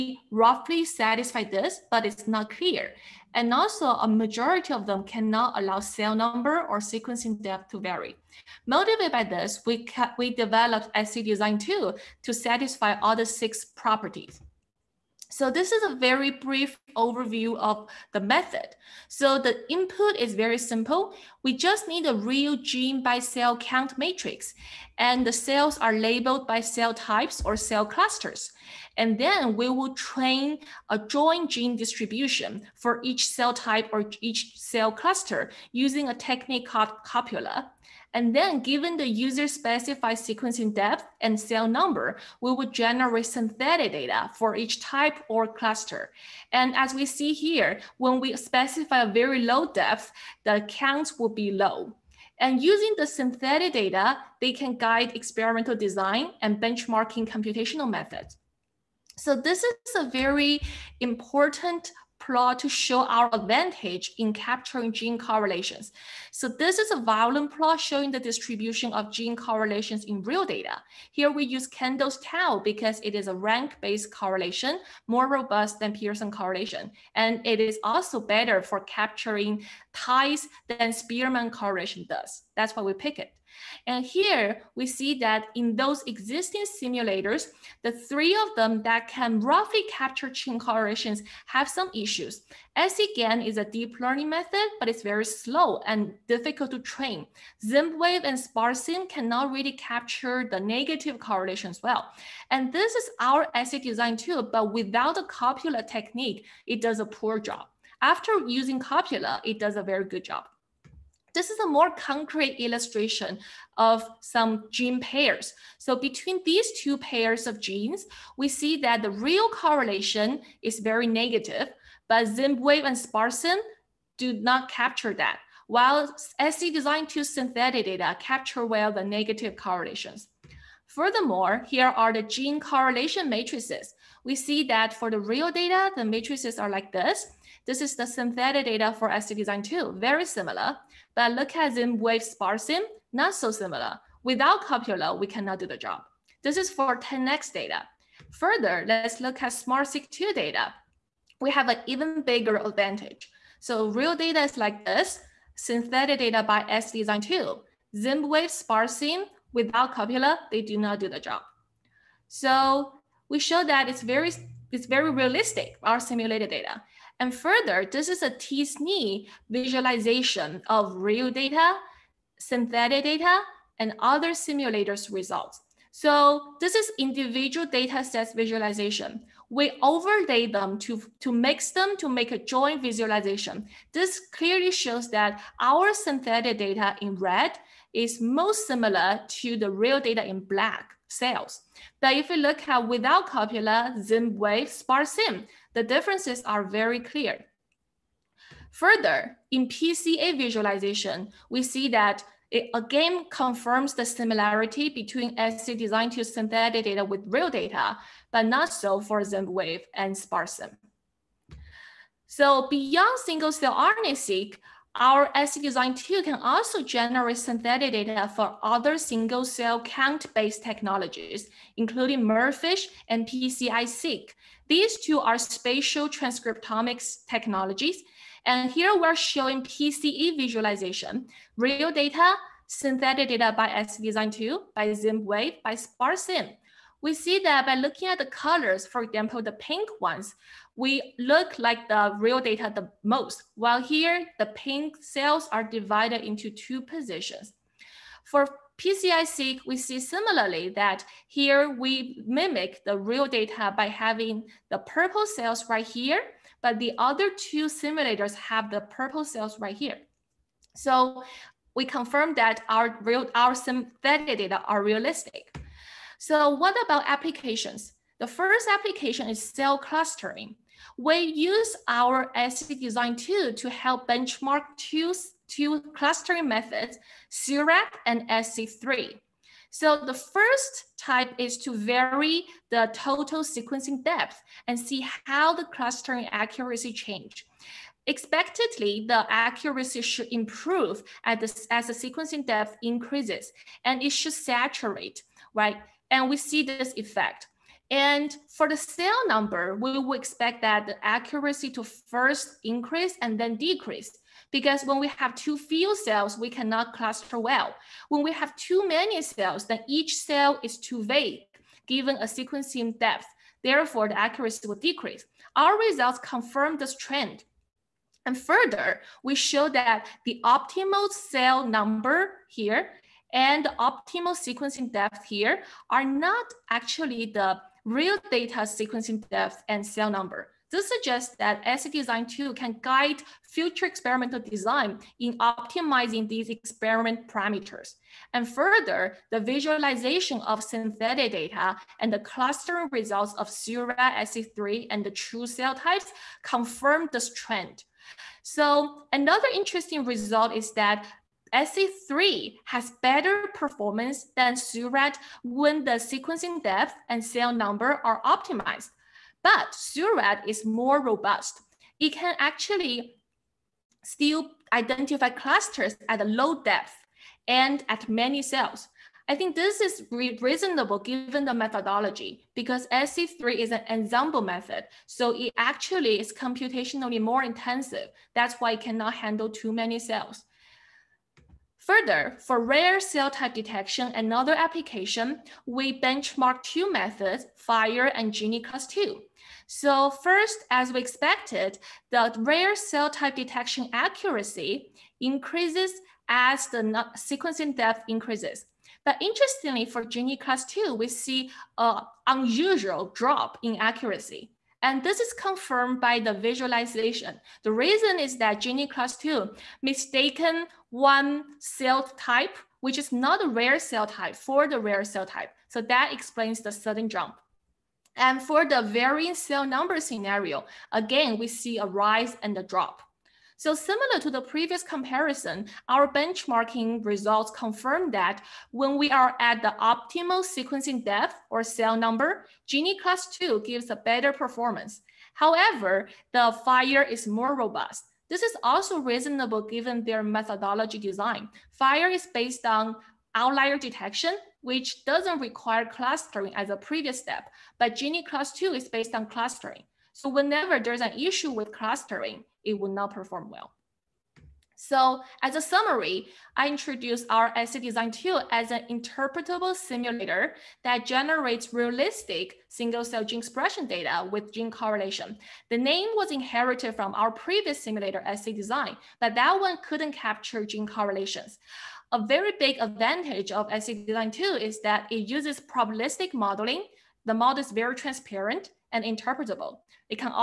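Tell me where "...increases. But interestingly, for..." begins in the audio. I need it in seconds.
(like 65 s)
398 s.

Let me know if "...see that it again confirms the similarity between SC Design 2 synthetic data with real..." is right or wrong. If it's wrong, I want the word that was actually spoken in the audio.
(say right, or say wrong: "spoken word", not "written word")
right.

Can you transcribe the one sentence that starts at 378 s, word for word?
That's why it cannot handle too many cells.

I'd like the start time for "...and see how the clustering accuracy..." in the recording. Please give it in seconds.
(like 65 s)
284 s.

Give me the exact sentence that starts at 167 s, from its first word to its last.
And further, this is a T-SNE visualization of real data, synthetic data, and other simulators results.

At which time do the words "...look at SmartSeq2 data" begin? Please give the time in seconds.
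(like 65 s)
149 s.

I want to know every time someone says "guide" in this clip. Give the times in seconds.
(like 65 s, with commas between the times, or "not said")
54 s, 332 s.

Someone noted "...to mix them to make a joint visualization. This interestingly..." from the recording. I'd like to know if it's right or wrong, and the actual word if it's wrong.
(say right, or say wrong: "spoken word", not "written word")
wrong: "clearly", not "interestingly".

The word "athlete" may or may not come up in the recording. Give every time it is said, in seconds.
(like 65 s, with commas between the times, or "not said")
not said.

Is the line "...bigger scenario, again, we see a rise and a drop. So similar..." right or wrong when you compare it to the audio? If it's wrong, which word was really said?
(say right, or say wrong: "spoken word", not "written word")
wrong: "number", not "bigger".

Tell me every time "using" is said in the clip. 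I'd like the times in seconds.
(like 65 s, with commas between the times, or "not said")
35 s, 52 s, 108 s.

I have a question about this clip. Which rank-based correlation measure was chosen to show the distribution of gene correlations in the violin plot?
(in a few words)
Kendall's tau.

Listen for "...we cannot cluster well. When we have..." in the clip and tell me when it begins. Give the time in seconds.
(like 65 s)
306 s.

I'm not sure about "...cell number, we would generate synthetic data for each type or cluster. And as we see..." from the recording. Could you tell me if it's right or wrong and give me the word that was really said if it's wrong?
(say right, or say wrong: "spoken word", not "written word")
right.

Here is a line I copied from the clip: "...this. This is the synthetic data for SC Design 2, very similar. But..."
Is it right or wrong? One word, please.
right.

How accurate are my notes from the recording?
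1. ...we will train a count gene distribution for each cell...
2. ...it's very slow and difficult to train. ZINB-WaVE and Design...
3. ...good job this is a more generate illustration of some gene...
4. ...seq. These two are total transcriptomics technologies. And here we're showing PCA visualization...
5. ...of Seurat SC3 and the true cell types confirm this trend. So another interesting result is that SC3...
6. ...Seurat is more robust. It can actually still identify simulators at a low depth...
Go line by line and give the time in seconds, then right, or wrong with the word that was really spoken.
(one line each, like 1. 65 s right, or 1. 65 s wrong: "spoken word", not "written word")
1. 29 s wrong: "joint", not "count"
2. 94 s wrong: "SPARSim", not "Design"
3. 110 s wrong: "concrete", not "generate"
4. 223 s wrong: "spatial", not "total"
5. 343 s right
6. 359 s wrong: "clusters", not "simulators".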